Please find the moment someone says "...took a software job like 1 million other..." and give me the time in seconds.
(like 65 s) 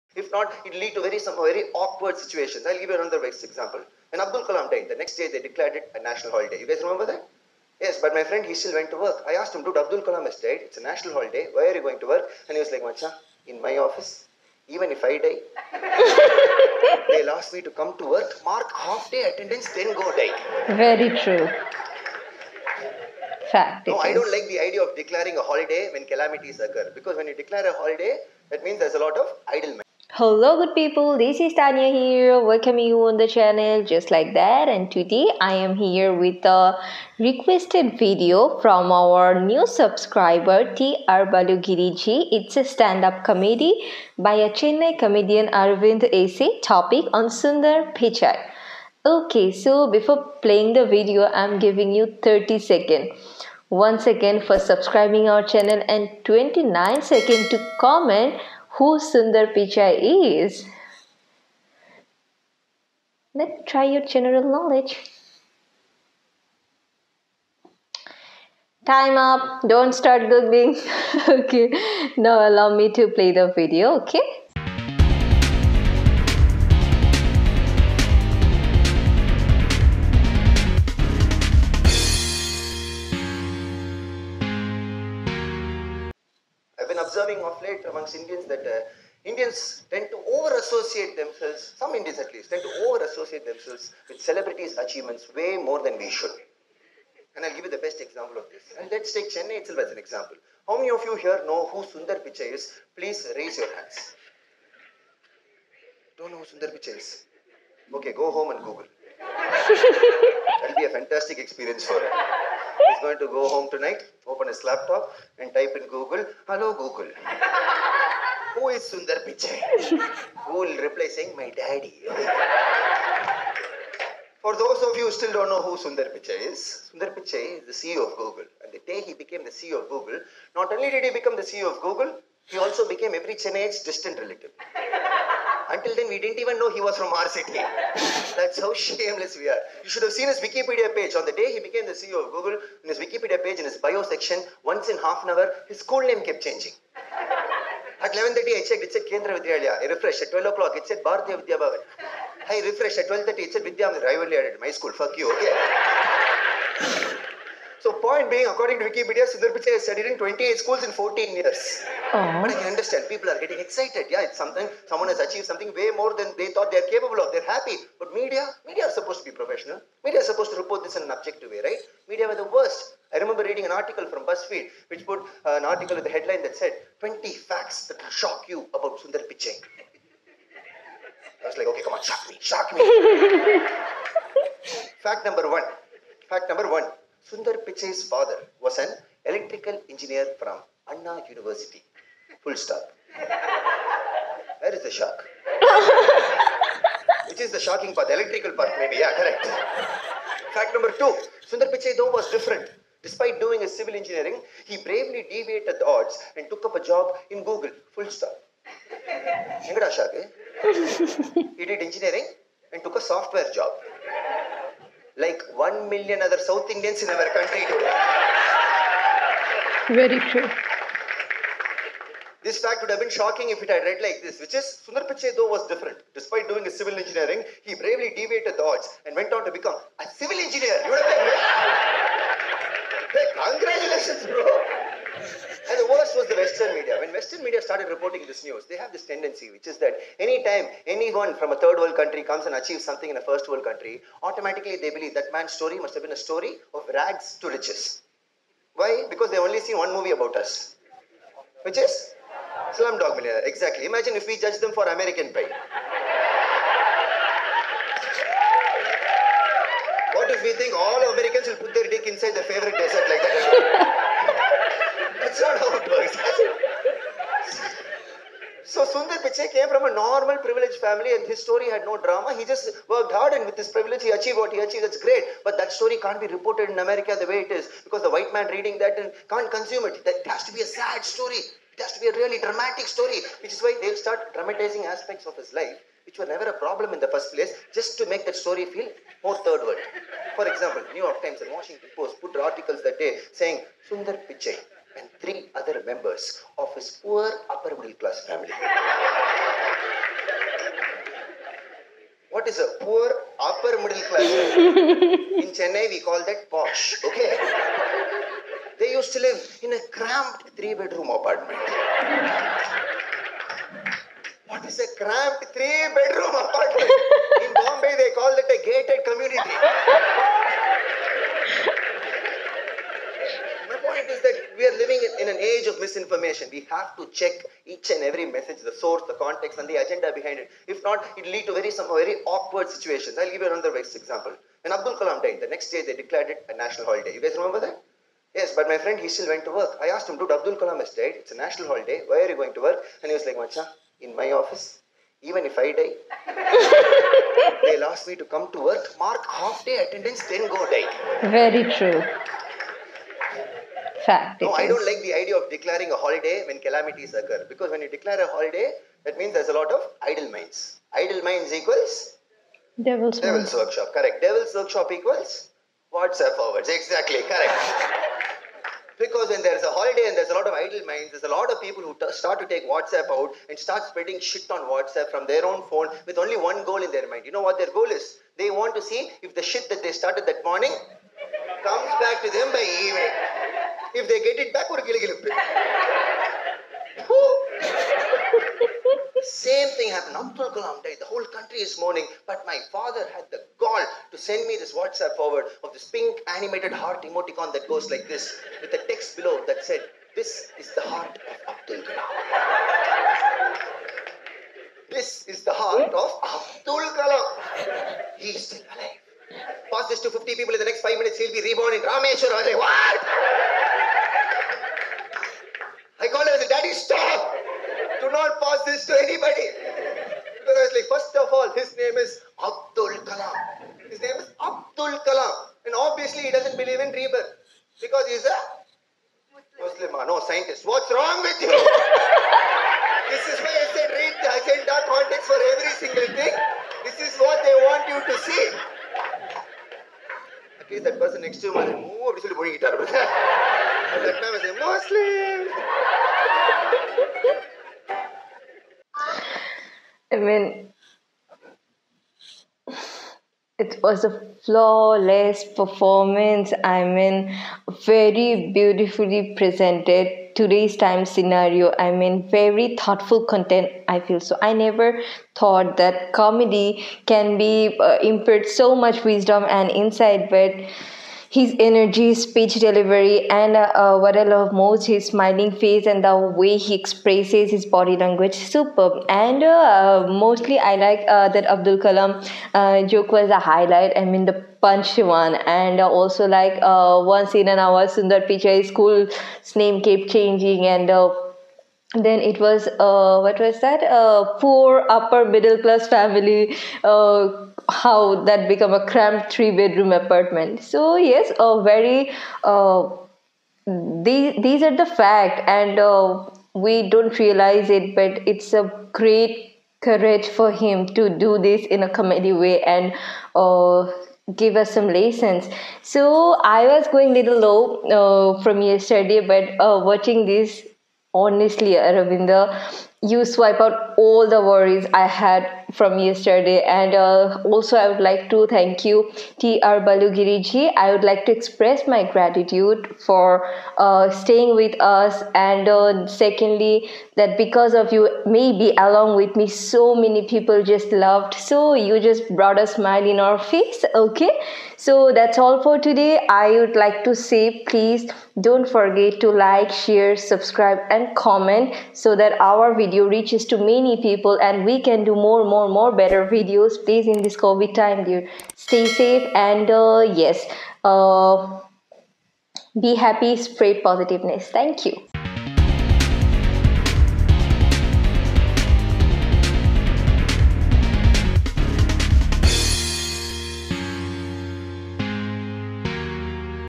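212 s.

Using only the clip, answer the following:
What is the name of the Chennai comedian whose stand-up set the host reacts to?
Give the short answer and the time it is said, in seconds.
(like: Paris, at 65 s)
Aravind A C, at 45 s.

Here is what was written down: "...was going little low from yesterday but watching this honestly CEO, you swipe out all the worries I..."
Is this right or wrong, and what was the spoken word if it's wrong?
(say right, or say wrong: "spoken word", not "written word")
wrong: "Aravinda", not "CEO".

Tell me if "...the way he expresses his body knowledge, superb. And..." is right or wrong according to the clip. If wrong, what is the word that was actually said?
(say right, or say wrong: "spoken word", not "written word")
wrong: "language", not "knowledge".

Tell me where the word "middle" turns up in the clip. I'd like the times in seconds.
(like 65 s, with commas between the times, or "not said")
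297 s, 303 s, 495 s.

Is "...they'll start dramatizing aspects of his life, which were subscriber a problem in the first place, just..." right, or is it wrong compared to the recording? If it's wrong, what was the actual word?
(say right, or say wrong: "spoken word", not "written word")
wrong: "never", not "subscriber".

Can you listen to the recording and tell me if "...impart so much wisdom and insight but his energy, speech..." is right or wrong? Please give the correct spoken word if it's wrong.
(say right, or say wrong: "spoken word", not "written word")
right.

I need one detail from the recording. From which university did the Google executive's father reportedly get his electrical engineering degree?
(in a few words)
Anna University.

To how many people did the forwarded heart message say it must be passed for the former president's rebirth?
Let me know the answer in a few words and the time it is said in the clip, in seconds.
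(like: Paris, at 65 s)
50, at 410 s.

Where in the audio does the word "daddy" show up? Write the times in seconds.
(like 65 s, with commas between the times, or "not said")
121 s, 416 s.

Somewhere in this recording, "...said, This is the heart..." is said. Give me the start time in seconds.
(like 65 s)
399 s.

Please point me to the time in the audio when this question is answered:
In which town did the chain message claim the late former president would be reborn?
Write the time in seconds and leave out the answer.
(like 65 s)
411 s.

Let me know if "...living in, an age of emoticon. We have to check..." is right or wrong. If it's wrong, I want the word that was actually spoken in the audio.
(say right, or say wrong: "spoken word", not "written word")
wrong: "misinformation", not "emoticon".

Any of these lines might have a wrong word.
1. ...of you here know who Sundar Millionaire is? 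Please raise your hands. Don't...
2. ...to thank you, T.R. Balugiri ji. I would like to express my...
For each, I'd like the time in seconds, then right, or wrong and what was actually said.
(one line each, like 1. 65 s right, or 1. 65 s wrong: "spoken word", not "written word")
1. 100 s wrong: "Pichai", not "Millionaire"
2. 528 s right.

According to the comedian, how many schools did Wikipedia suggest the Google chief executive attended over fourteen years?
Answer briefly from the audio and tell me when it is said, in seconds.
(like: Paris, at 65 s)
28, at 160 s.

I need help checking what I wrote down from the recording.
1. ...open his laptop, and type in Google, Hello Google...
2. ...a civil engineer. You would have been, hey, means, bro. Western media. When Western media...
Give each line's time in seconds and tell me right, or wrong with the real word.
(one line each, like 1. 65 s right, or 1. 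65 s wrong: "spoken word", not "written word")
1. 114 s right
2. 229 s wrong: "congratulations", not "means".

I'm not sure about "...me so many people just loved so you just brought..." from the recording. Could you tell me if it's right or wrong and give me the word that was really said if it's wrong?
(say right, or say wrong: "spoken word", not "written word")
right.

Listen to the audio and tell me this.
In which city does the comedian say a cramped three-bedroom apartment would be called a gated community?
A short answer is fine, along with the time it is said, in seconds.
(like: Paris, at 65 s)
Bombay, at 317 s.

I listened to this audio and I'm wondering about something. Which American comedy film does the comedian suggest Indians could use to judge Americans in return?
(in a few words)
American Pie.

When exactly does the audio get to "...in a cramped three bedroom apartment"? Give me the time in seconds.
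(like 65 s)
309 s.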